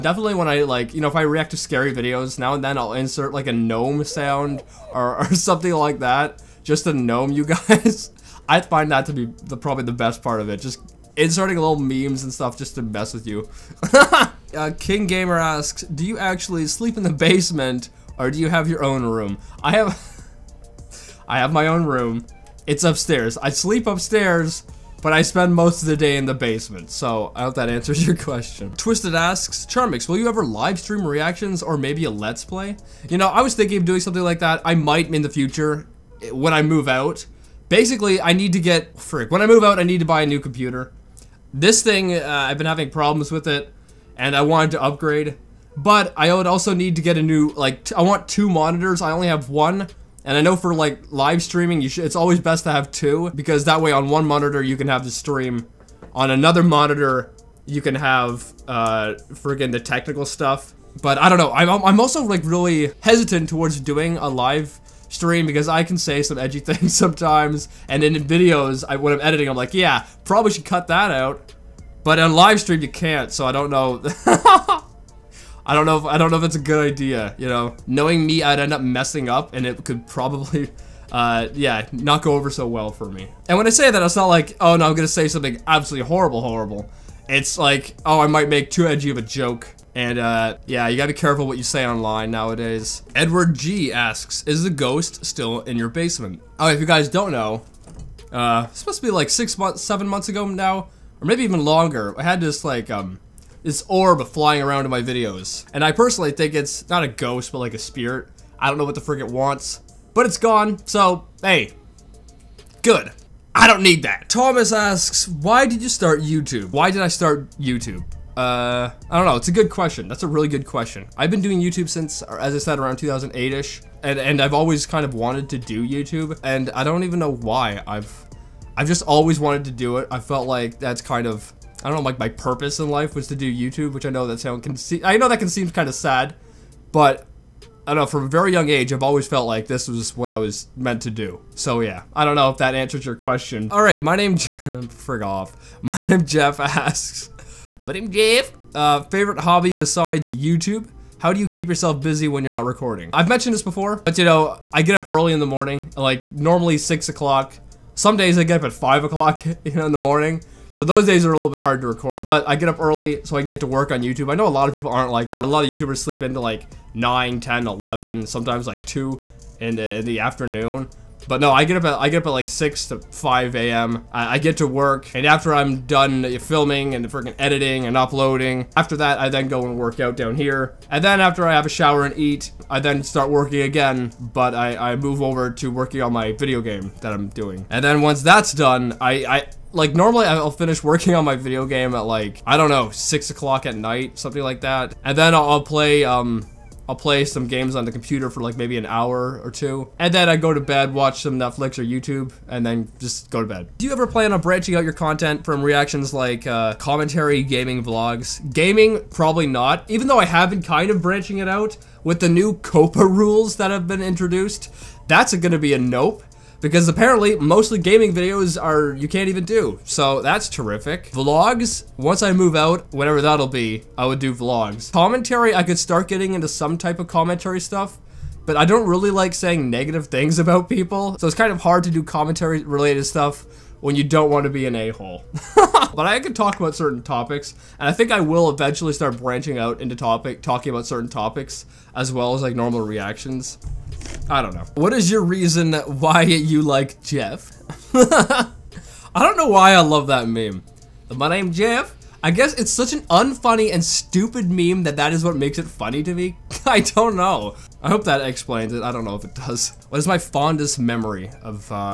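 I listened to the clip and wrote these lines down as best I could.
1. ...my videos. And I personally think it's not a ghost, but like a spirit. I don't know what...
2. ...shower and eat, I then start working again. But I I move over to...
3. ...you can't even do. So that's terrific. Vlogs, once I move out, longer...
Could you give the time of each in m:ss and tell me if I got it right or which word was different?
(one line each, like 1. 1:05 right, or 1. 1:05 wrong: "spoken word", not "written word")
1. 1:44 right
2. 3:01 right
3. 3:38 wrong: "whatever", not "longer".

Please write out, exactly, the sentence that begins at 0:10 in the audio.
Just inserting little memes and stuff just to mess with you.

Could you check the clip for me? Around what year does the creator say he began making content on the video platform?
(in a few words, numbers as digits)
2008.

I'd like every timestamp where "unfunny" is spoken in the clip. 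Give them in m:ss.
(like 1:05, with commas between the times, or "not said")
4:13.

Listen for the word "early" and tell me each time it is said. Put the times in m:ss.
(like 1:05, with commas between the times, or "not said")
2:35, 2:42.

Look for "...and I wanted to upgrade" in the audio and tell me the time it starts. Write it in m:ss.
0:44.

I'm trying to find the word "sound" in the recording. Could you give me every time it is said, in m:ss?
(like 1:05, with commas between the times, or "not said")
0:04, 2:14.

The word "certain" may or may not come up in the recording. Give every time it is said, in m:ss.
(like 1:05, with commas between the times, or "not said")
3:56, 4:00.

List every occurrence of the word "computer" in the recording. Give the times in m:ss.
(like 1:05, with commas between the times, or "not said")
0:40, 3:17.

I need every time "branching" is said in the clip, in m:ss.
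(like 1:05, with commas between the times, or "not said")
3:24, 3:31, 3:59.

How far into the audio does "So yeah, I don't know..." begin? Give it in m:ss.
2:21.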